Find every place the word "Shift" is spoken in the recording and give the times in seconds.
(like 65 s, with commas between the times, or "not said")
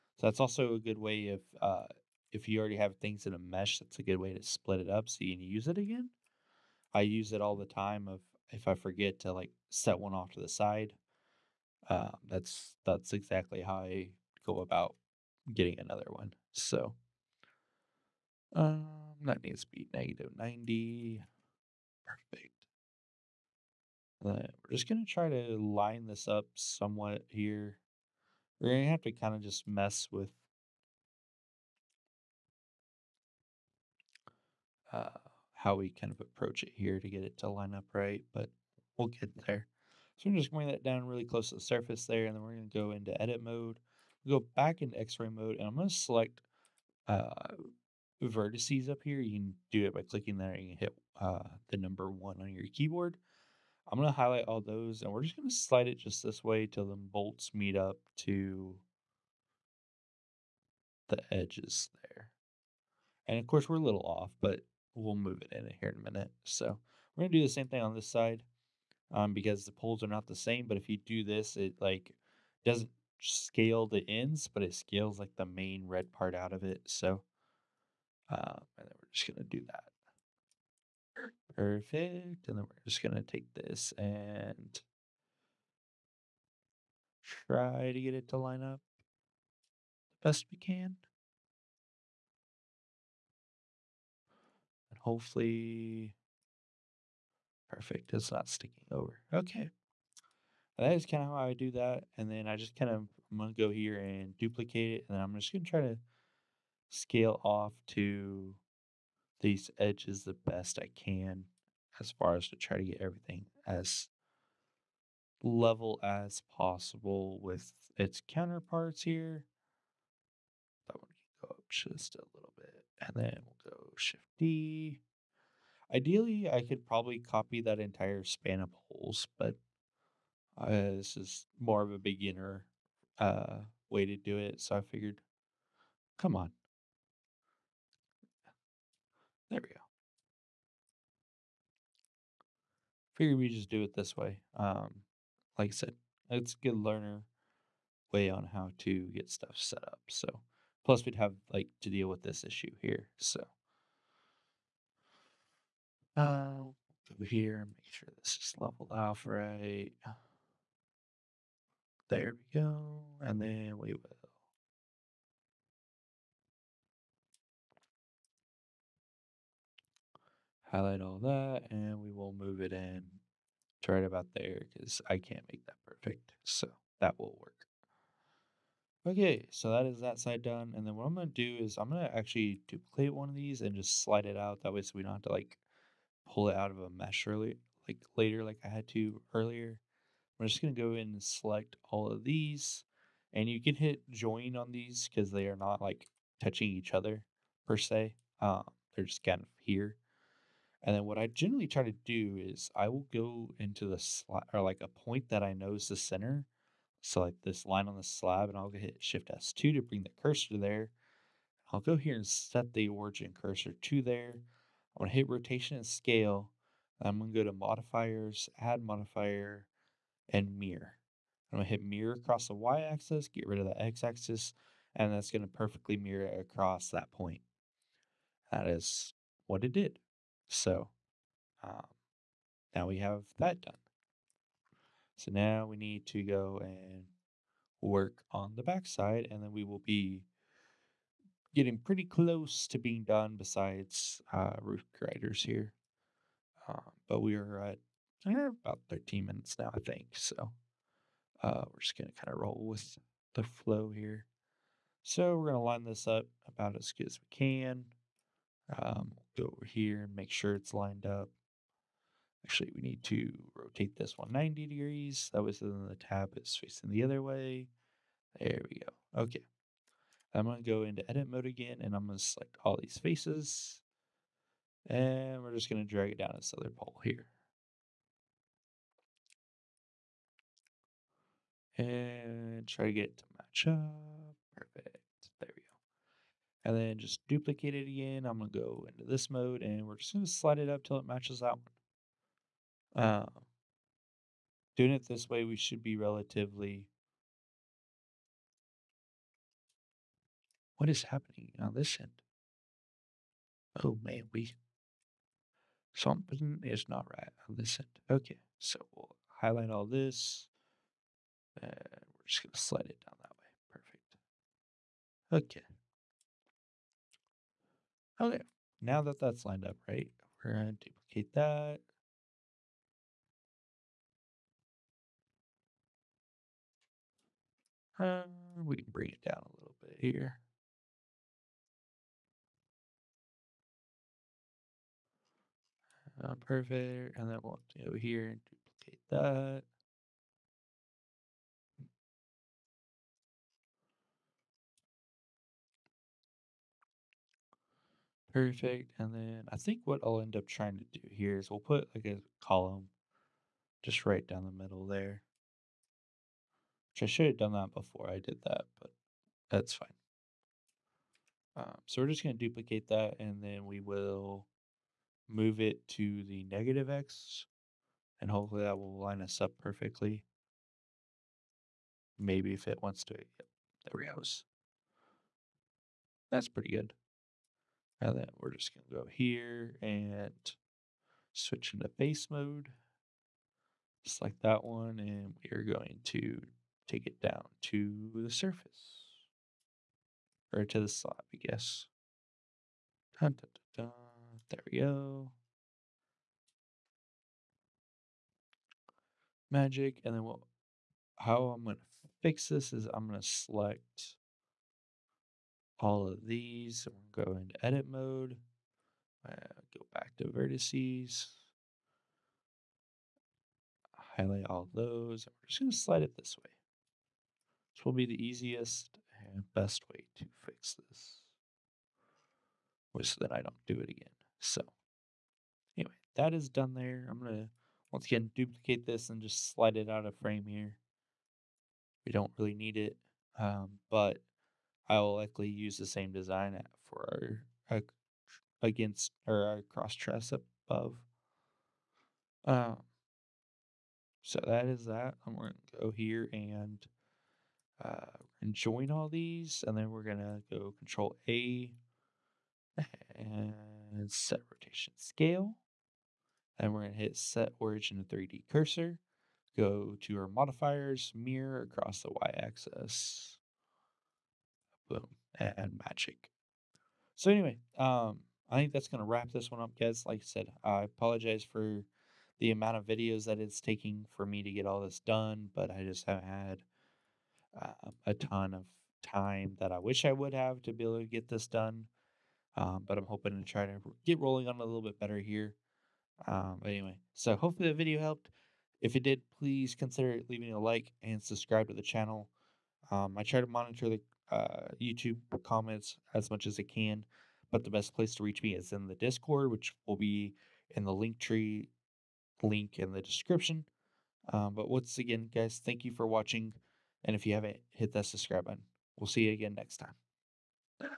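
123 s, 209 s.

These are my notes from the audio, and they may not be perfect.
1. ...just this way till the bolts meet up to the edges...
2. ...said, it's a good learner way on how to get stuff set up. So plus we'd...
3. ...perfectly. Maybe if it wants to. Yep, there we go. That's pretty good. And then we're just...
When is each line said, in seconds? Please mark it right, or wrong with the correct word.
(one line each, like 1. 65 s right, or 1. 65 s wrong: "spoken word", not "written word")
1. 55 s right
2. 145 s right
3. 369 s right.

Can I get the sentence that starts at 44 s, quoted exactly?
Go back in X-ray mode, and I'm going to select uh, vertices up here.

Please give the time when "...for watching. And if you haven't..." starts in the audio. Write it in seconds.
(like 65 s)
505 s.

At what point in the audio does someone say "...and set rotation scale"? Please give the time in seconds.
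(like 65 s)
453 s.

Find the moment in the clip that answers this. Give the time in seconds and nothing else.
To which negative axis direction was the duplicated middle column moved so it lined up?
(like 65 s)
366 s.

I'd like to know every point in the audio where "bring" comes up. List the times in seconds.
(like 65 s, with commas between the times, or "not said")
40 s, 209 s, 328 s.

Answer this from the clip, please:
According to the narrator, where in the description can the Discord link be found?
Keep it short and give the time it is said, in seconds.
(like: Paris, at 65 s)
LinkTree link, at 500 s.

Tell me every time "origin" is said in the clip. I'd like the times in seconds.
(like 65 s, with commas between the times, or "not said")
212 s, 457 s.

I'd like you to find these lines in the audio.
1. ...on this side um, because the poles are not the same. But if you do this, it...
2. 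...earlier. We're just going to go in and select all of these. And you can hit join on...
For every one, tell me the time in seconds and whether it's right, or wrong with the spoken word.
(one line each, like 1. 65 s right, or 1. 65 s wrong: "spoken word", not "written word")
1. 67 s right
2. 189 s right.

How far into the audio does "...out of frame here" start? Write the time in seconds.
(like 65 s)
429 s.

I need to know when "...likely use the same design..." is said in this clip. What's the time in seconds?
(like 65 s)
435 s.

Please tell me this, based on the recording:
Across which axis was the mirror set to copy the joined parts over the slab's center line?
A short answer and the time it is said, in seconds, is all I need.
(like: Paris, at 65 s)
Y axis, at 222 s.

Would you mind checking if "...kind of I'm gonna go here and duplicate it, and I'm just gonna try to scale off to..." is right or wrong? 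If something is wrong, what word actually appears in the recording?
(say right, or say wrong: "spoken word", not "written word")
right.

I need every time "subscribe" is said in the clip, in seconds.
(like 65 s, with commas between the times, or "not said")
491 s, 508 s.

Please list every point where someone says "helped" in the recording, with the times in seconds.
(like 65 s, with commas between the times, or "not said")
488 s.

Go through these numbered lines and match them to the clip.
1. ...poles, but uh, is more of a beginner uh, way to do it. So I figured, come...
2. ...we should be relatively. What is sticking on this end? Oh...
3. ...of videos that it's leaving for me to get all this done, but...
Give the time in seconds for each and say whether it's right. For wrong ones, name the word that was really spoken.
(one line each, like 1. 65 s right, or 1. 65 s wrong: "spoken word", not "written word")
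1. 128 s wrong: "holes", not "poles"
2. 295 s wrong: "happening", not "sticking"
3. 472 s wrong: "taking", not "leaving".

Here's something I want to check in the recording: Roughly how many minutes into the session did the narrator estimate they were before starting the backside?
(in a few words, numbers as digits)
13.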